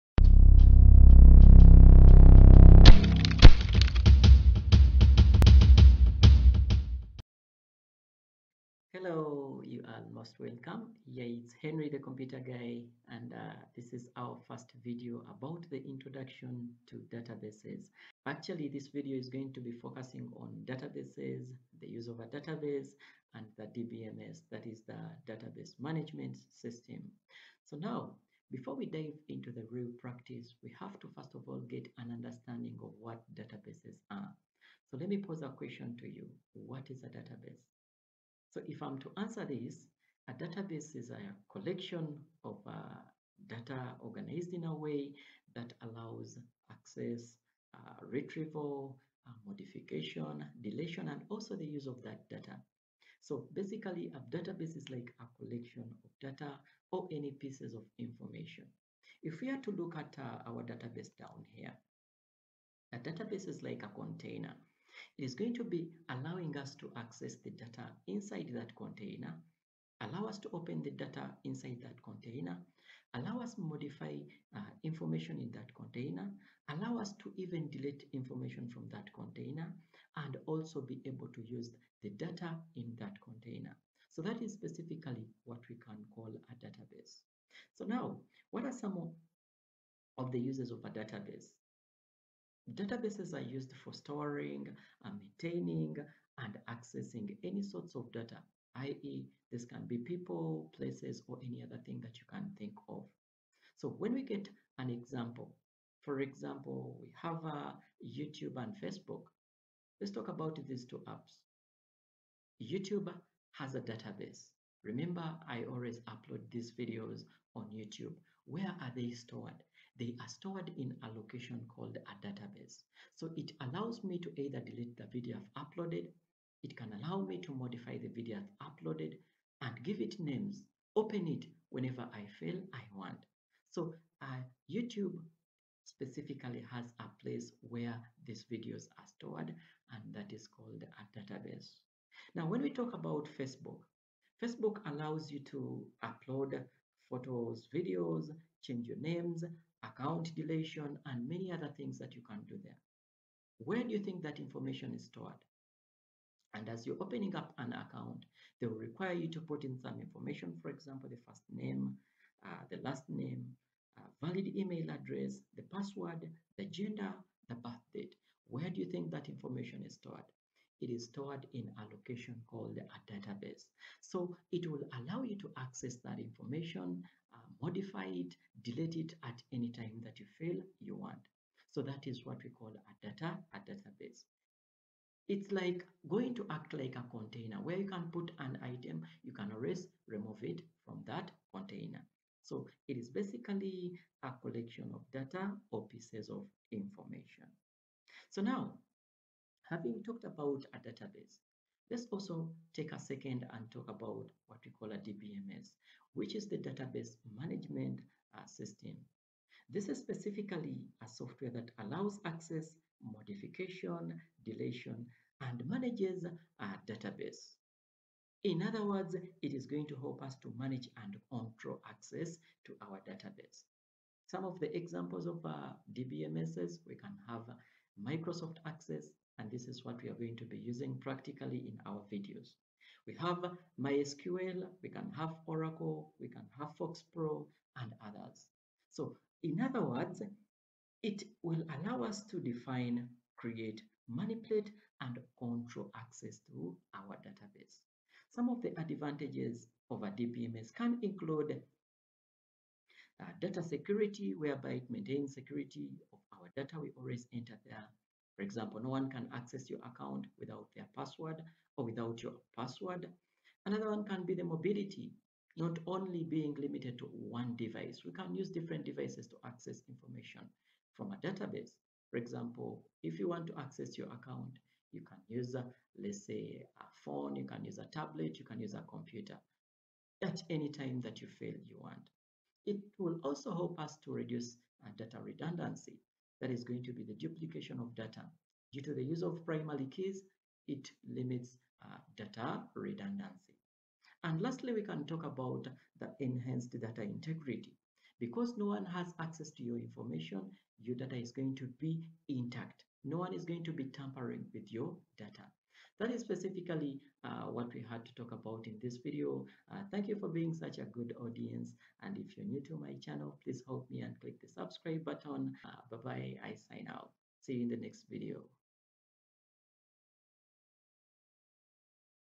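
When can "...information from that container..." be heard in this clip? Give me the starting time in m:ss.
1:18.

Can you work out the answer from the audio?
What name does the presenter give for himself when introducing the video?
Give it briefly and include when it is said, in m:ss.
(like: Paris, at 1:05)
Henry the Computer Guy, at 0:11.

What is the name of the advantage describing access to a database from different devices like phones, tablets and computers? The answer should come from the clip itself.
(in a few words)
mobility.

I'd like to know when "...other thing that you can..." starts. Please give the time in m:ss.
1:41.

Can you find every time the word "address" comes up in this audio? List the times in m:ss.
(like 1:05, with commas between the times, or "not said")
2:44.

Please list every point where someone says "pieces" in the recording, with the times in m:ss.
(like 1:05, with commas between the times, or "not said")
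0:57, 3:15.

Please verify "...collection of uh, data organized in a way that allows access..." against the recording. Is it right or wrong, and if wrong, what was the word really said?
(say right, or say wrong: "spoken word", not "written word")
right.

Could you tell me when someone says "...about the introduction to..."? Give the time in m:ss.
0:15.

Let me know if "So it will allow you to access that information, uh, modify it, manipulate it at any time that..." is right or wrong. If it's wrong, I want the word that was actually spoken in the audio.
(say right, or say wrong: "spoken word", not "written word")
wrong: "delete", not "manipulate".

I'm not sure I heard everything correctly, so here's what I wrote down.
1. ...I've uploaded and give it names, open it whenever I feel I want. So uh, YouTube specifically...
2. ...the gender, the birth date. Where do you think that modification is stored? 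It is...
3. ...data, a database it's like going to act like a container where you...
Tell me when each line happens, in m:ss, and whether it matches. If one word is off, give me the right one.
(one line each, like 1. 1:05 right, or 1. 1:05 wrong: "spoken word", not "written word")
1. 2:08 right
2. 2:46 wrong: "information", not "modification"
3. 3:03 right.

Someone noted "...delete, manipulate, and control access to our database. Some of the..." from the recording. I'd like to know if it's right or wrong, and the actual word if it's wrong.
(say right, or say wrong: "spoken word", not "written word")
wrong: "create", not "delete".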